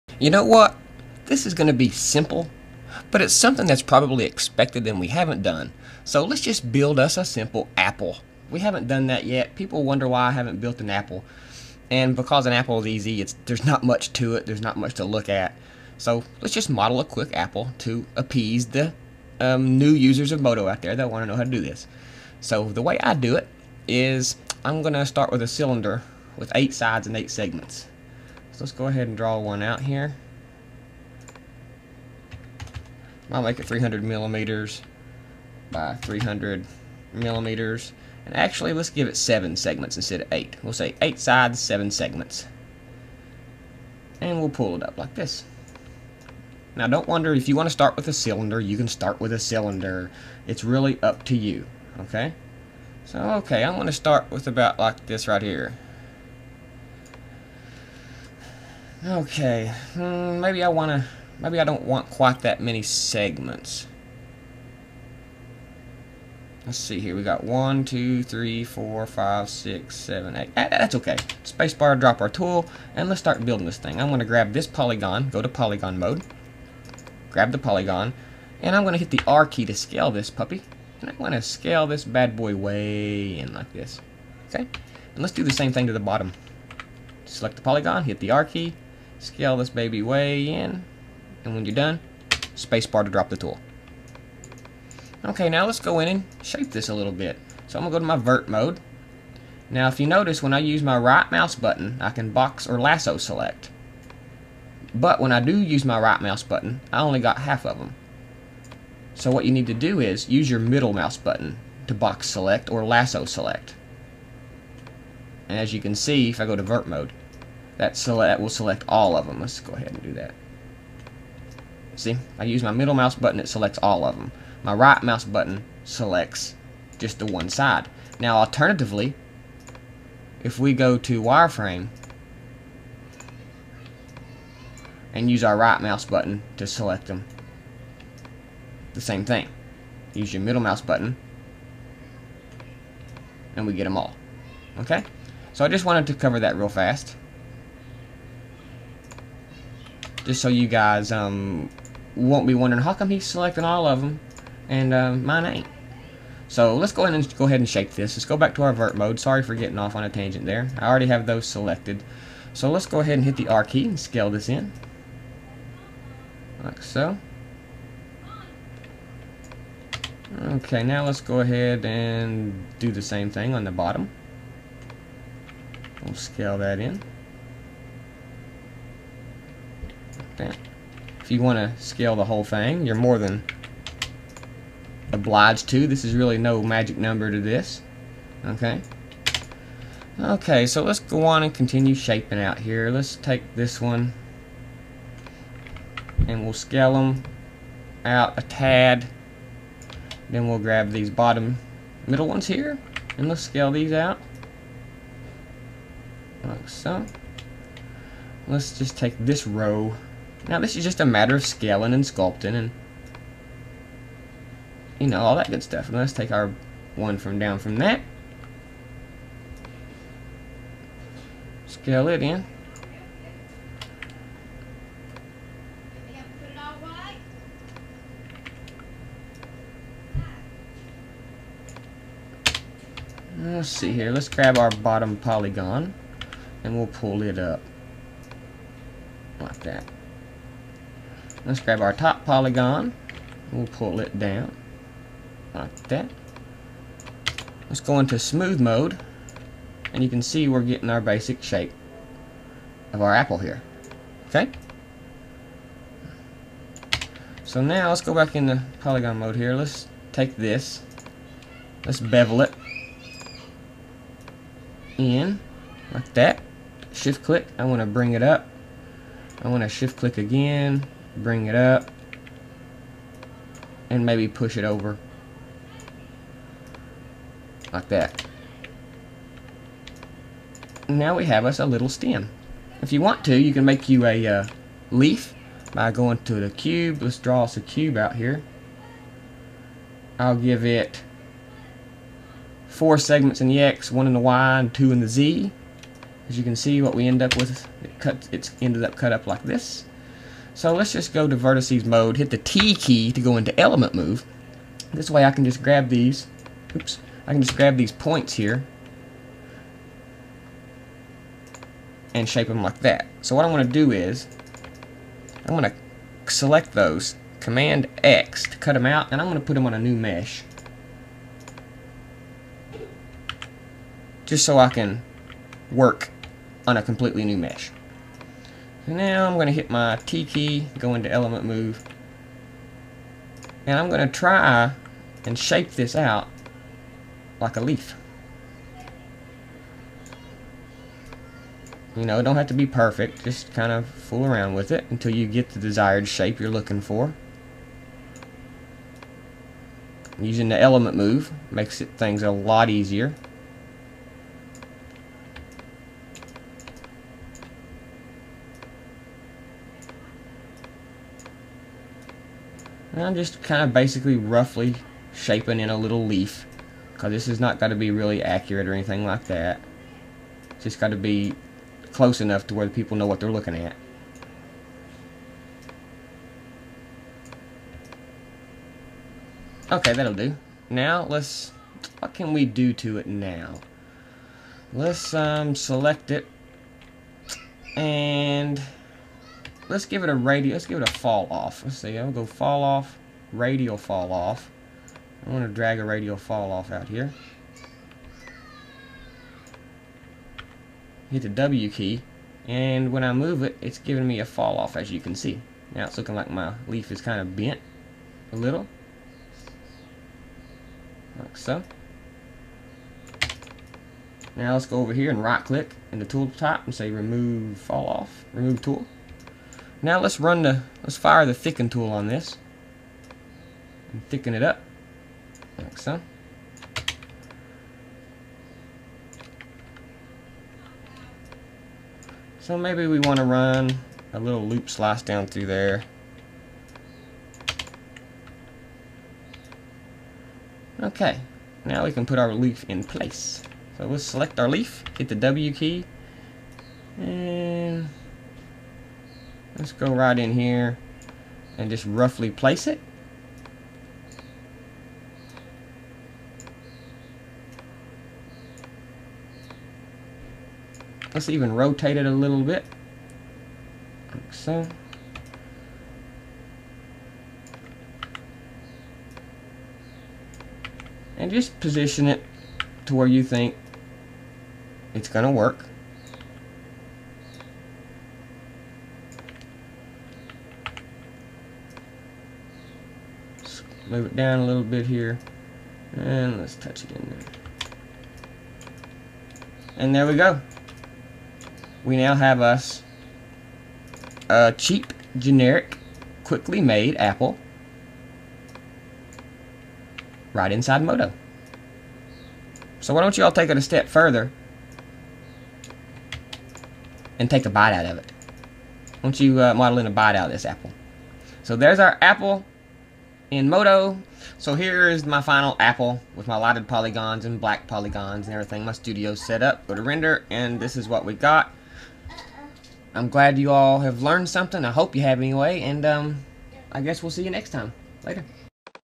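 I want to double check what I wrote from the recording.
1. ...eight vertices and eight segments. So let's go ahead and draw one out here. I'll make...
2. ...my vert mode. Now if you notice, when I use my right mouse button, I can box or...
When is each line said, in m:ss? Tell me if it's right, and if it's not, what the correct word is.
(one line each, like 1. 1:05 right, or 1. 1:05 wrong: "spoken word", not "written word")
1. 0:26 wrong: "sides", not "vertices"
2. 1:38 right.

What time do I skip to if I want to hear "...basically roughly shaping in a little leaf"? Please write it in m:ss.
6:03.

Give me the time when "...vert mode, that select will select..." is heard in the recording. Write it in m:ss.
1:56.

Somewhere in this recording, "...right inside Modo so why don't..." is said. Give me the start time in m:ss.
8:20.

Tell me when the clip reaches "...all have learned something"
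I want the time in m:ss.
8:43.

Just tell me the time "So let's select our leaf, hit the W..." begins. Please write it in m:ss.
7:23.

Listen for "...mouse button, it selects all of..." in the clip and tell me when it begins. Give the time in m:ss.
2:02.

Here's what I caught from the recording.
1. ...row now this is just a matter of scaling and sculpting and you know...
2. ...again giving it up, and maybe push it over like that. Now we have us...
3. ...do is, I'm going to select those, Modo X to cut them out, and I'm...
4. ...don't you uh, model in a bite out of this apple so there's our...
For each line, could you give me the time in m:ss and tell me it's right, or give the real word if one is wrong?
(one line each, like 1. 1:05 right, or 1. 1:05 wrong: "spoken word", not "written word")
1. 3:29 right
2. 4:30 wrong: "bring", not "giving"
3. 5:13 wrong: "Command", not "Modo"
4. 8:29 right.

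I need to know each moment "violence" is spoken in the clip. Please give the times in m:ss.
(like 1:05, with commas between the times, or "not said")
not said.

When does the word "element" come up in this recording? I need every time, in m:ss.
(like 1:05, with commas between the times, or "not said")
5:03, 5:31, 5:50.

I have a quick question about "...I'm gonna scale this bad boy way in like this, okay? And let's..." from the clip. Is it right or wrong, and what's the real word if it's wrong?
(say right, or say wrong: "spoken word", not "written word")
right.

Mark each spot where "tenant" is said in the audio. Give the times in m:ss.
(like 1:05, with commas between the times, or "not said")
not said.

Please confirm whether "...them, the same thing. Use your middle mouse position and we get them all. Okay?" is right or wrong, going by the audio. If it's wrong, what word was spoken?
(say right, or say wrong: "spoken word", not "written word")
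wrong: "button", not "position".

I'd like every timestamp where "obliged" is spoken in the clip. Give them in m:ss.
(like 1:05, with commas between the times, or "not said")
3:05.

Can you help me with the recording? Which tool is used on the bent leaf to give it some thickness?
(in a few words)
thicken tool.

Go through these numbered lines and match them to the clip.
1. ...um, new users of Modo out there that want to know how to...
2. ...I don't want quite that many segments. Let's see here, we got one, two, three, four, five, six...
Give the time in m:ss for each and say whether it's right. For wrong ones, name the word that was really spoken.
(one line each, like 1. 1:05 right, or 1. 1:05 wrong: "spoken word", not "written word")
1. 0:19 right
2. 1:01 right.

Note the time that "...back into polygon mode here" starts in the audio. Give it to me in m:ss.
4:18.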